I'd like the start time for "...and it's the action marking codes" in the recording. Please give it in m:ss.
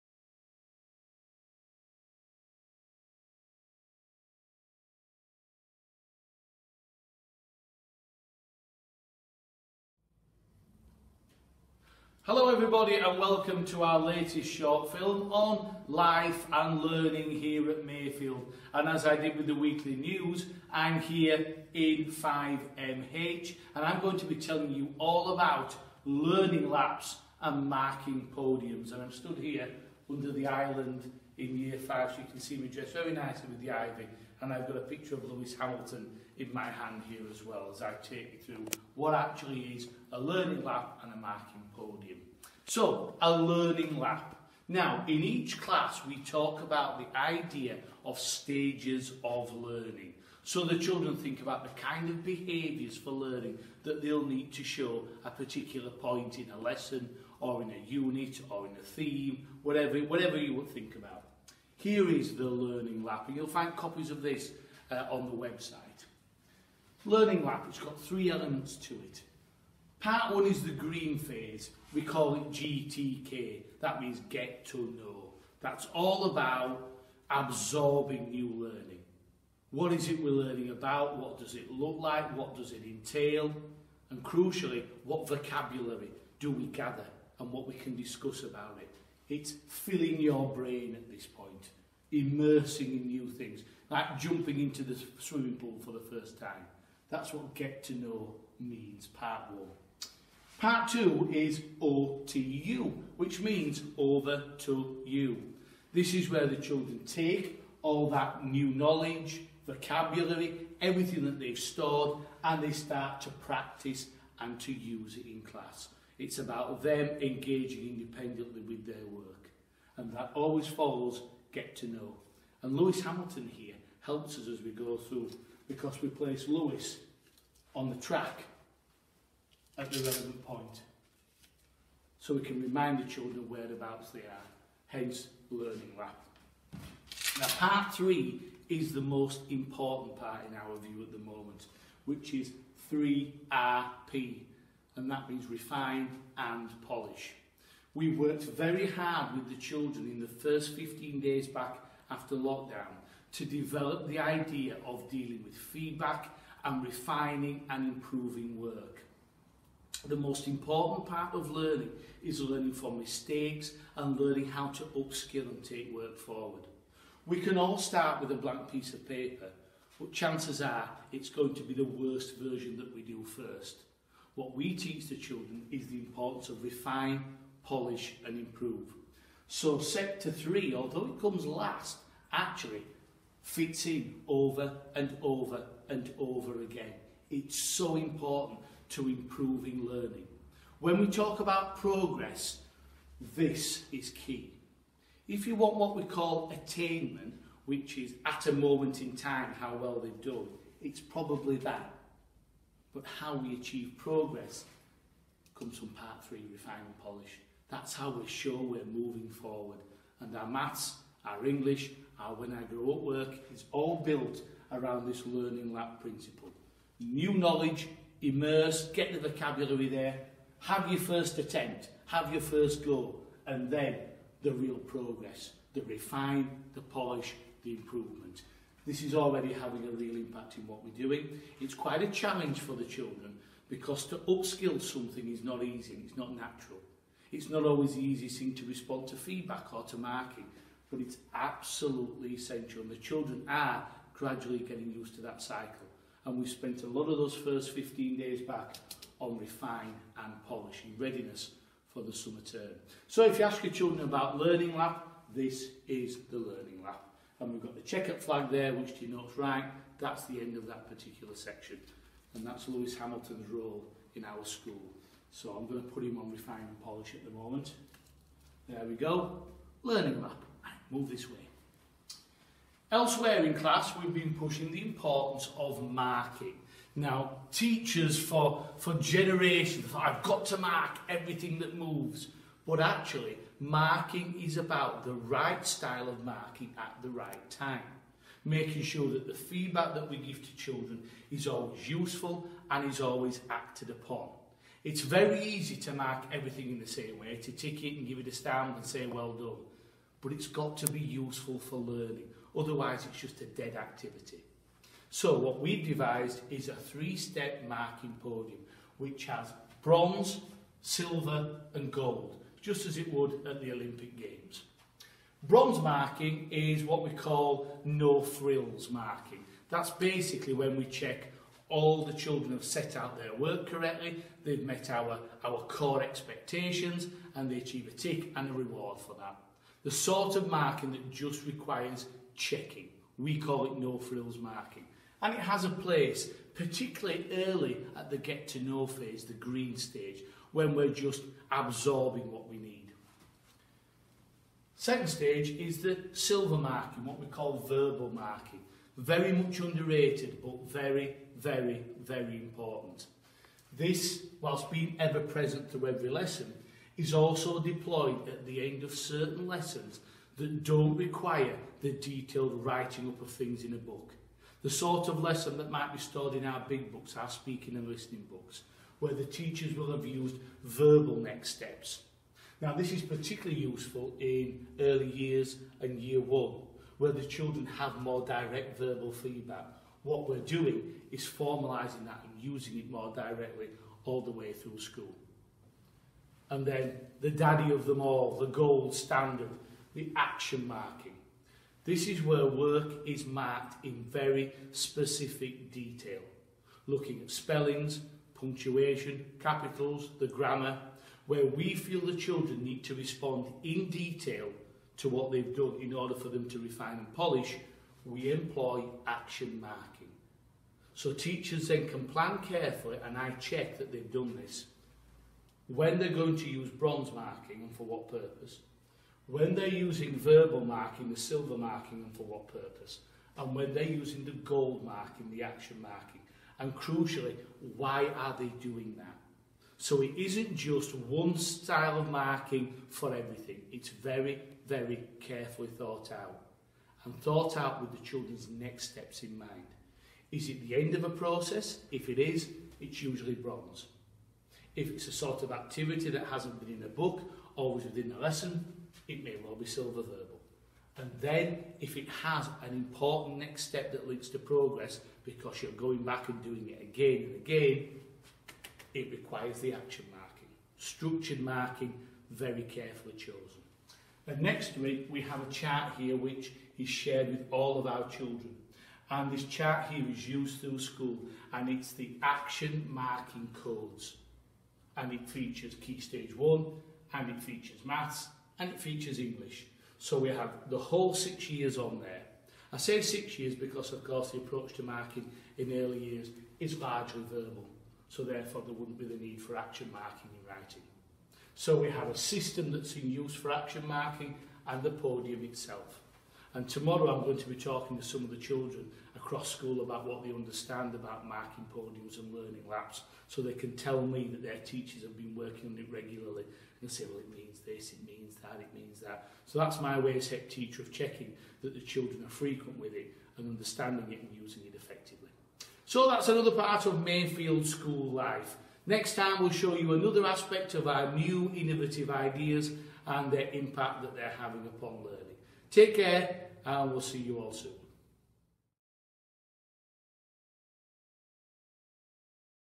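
7:51.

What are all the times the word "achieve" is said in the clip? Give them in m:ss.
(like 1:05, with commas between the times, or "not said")
3:23, 5:27.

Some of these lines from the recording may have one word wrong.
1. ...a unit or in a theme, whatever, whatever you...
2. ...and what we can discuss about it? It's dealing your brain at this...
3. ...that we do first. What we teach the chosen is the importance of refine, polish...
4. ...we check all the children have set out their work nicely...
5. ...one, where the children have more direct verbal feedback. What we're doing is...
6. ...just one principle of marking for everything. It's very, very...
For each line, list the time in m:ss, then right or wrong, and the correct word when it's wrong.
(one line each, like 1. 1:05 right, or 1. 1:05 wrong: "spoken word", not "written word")
1. 0:57 right
2. 1:27 wrong: "filling", not "dealing"
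3. 2:52 wrong: "children", not "chosen"
4. 5:20 wrong: "correctly", not "nicely"
5. 6:16 right
6. 7:10 wrong: "style", not "principle".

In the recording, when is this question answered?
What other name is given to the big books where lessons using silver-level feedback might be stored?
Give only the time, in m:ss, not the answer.
6:07.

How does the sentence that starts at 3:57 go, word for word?
It's not always the easiest thing to respond to feedback or to marking, but it's absolutely essential.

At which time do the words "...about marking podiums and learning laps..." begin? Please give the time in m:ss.
8:20.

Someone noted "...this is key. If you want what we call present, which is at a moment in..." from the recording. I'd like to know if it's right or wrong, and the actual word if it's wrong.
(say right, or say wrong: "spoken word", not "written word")
wrong: "attainment", not "present".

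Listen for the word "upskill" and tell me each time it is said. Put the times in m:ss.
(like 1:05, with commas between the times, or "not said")
2:44, 3:54.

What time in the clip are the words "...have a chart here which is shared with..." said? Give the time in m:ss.
7:45.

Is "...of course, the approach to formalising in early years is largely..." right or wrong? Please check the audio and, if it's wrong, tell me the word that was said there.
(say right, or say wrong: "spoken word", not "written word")
wrong: "marking", not "formalising".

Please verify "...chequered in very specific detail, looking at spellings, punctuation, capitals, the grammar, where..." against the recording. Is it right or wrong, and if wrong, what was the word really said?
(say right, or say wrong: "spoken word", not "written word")
wrong: "marked", not "chequered".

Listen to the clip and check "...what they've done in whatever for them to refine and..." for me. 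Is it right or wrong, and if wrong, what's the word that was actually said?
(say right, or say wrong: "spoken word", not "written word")
wrong: "order", not "whatever".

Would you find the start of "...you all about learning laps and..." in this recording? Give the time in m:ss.
0:24.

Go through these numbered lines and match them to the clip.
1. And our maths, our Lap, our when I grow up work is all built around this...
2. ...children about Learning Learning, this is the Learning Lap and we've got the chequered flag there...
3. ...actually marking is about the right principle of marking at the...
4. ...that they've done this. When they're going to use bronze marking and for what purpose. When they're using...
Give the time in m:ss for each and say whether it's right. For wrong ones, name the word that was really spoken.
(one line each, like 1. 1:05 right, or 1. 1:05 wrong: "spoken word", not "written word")
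1. 3:30 wrong: "English", not "Lap"
2. 4:13 wrong: "Lap", not "Learning"
3. 4:42 wrong: "style", not "principle"
4. 6:53 right.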